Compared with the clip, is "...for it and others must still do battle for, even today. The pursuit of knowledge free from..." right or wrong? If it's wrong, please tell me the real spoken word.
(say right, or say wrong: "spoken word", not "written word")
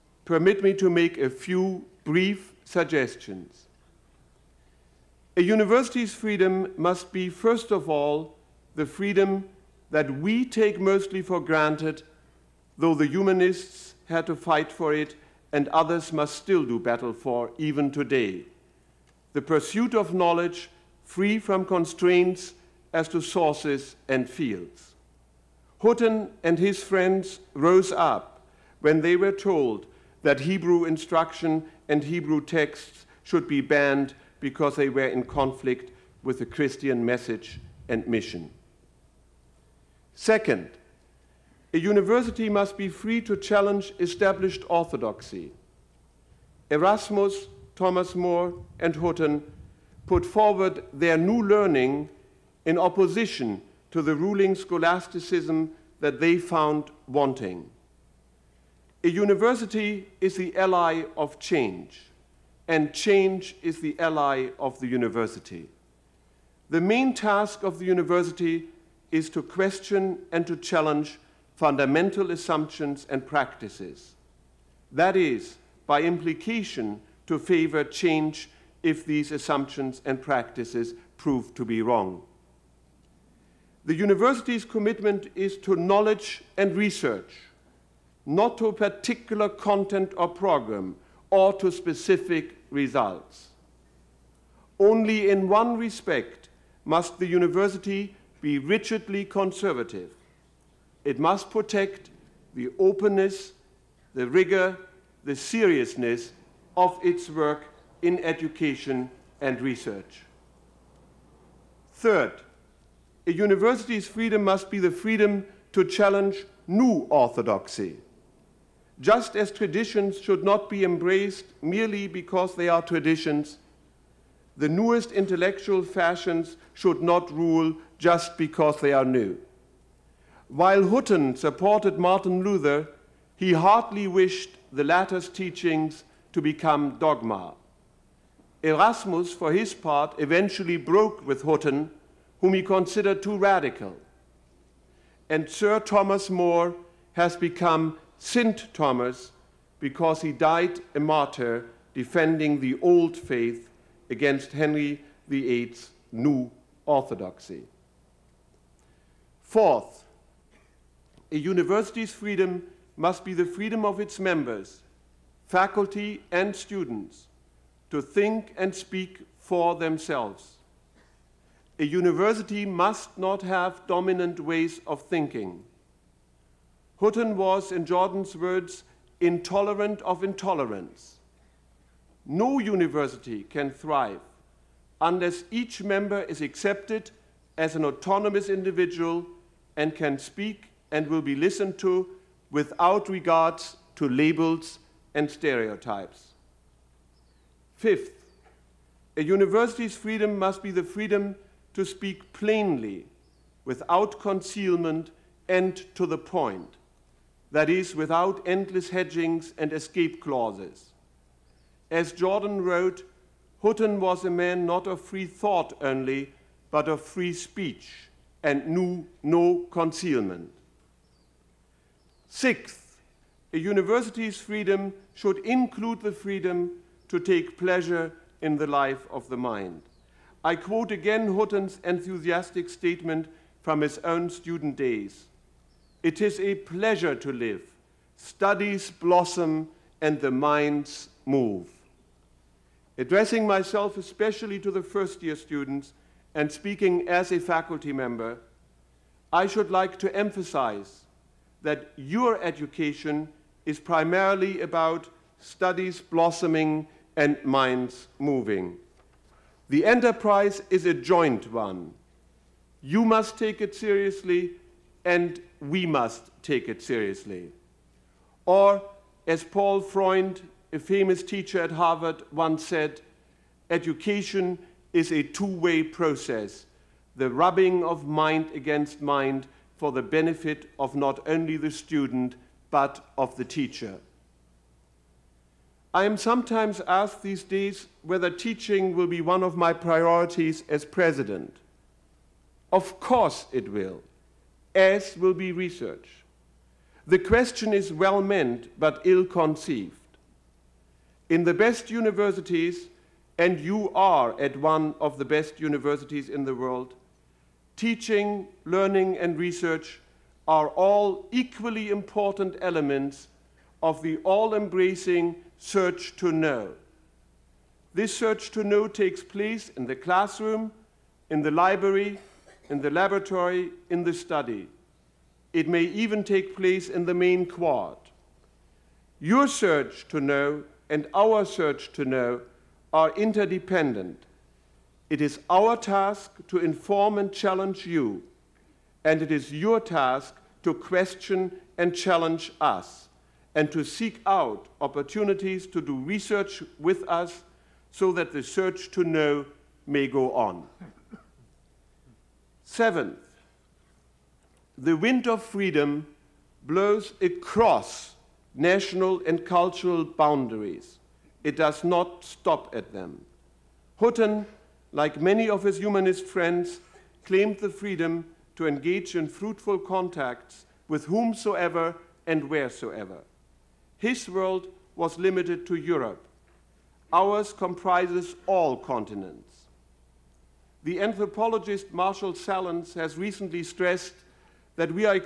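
right.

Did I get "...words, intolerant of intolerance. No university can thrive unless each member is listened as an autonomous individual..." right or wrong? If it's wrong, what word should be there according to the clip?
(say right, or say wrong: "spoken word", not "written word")
wrong: "accepted", not "listened".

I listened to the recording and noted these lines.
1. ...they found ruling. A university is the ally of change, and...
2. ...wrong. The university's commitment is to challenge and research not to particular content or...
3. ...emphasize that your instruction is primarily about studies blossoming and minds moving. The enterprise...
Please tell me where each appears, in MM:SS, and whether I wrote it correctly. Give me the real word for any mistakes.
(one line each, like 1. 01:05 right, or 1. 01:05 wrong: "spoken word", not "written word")
1. 00:56 wrong: "wanting", not "ruling"
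2. 01:21 wrong: "knowledge", not "challenge"
3. 04:10 wrong: "education", not "instruction".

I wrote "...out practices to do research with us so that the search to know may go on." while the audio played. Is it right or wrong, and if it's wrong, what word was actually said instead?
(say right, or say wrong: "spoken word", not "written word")
wrong: "opportunities", not "practices".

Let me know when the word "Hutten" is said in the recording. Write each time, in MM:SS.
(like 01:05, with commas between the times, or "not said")
00:25, 00:48, 02:10, 02:21, 02:56, 03:33, 03:51, 06:03.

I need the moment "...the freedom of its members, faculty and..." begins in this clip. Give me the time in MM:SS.
02:43.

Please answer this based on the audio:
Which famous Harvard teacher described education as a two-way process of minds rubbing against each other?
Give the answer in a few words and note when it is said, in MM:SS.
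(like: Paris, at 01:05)
Paul Freund, at 04:29.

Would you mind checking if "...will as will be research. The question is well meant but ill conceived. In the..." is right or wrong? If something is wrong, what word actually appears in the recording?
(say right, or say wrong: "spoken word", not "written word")
right.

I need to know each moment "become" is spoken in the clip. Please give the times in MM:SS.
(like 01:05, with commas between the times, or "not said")
02:16, 02:27.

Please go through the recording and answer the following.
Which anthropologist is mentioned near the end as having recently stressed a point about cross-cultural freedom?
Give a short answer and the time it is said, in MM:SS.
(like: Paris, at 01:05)
Marshall Sahlins, at 06:21.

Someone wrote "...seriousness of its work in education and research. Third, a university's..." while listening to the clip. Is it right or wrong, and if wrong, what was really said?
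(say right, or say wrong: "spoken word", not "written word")
right.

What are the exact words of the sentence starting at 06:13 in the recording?
His world was limited to Europe.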